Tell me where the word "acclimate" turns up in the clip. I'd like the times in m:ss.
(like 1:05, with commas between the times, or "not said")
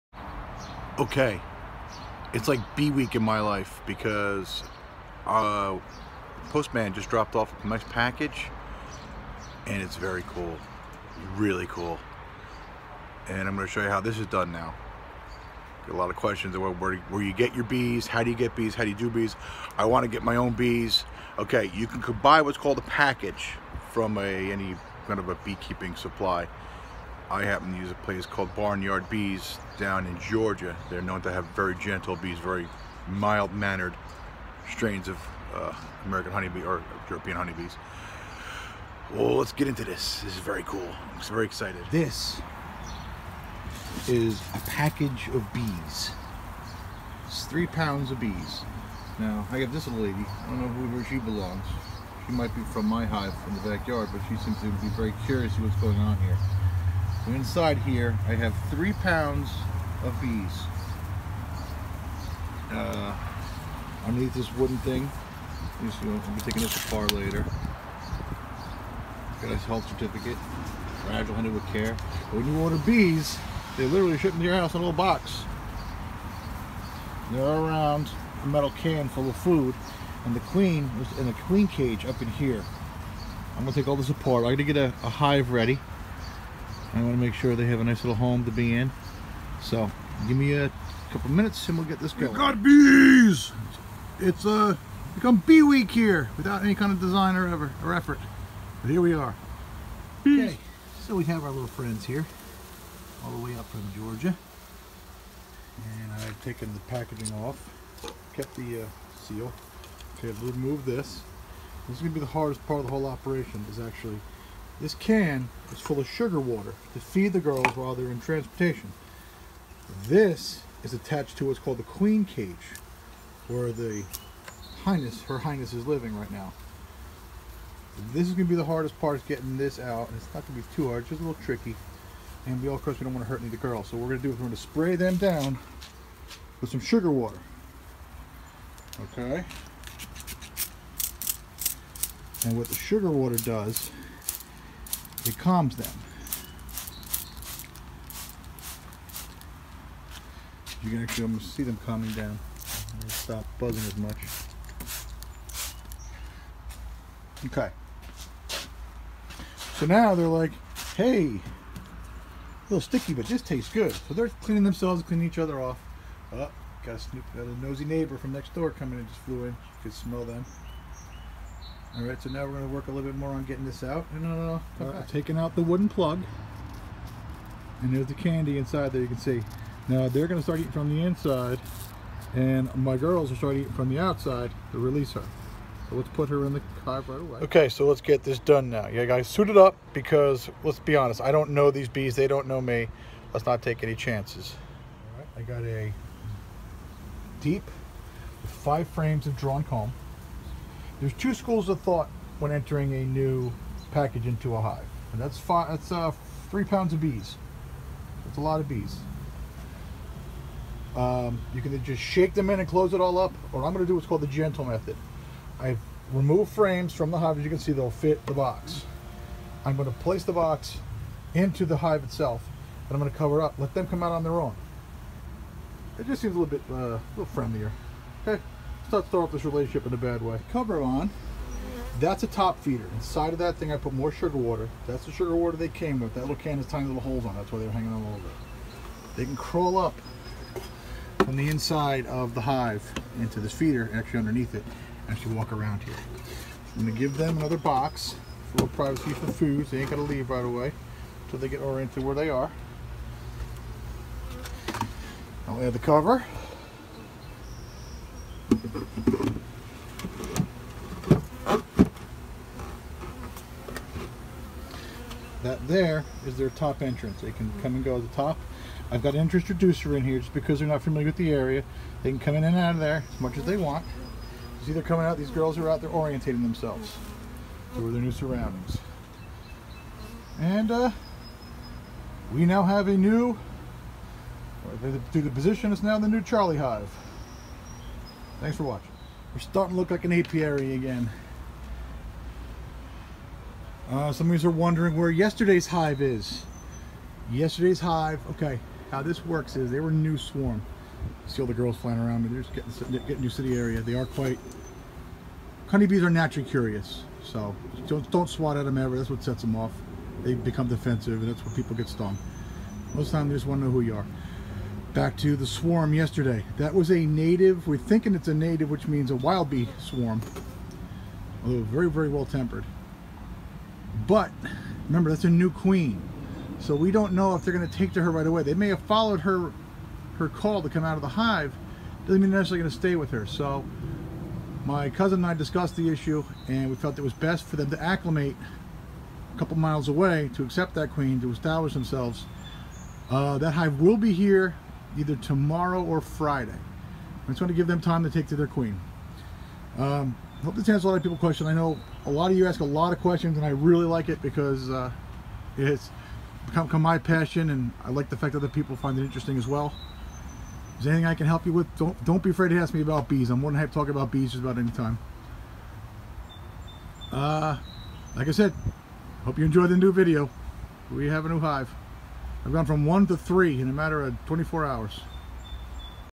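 5:37.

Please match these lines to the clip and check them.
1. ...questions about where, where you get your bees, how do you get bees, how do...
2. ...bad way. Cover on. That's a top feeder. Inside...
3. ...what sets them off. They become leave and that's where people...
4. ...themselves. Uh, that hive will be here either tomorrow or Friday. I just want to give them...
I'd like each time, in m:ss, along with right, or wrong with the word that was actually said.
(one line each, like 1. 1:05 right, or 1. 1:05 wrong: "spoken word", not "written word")
1. 0:16 right
2. 3:49 right
3. 5:09 wrong: "defensive", not "leave"
4. 5:41 right.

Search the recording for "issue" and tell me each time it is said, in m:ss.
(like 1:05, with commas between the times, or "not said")
5:35.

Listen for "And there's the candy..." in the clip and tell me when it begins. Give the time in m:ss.
2:57.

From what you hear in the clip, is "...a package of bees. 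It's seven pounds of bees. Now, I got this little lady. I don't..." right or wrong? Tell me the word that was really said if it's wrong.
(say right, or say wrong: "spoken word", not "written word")
wrong: "three", not "seven".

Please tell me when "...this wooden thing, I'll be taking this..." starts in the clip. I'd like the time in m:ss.
1:04.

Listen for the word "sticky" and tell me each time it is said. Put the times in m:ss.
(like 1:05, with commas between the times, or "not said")
2:42.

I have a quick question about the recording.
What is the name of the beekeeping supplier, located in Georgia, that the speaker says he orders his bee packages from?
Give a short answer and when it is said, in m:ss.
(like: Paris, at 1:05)
Barnyard Bees, at 0:28.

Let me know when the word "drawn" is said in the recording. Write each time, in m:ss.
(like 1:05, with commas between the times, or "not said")
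3:19.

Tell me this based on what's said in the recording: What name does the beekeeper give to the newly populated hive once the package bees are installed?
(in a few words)
Charlie Hive.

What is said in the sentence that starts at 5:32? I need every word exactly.
Doesn't mean they're necessarily going to stay with her.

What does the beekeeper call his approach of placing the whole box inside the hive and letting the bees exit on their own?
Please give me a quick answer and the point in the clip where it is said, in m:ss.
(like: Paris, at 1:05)
The gentle method, at 3:34.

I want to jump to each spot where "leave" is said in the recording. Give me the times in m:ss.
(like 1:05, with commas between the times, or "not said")
4:10.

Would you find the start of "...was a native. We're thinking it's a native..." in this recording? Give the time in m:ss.
5:16.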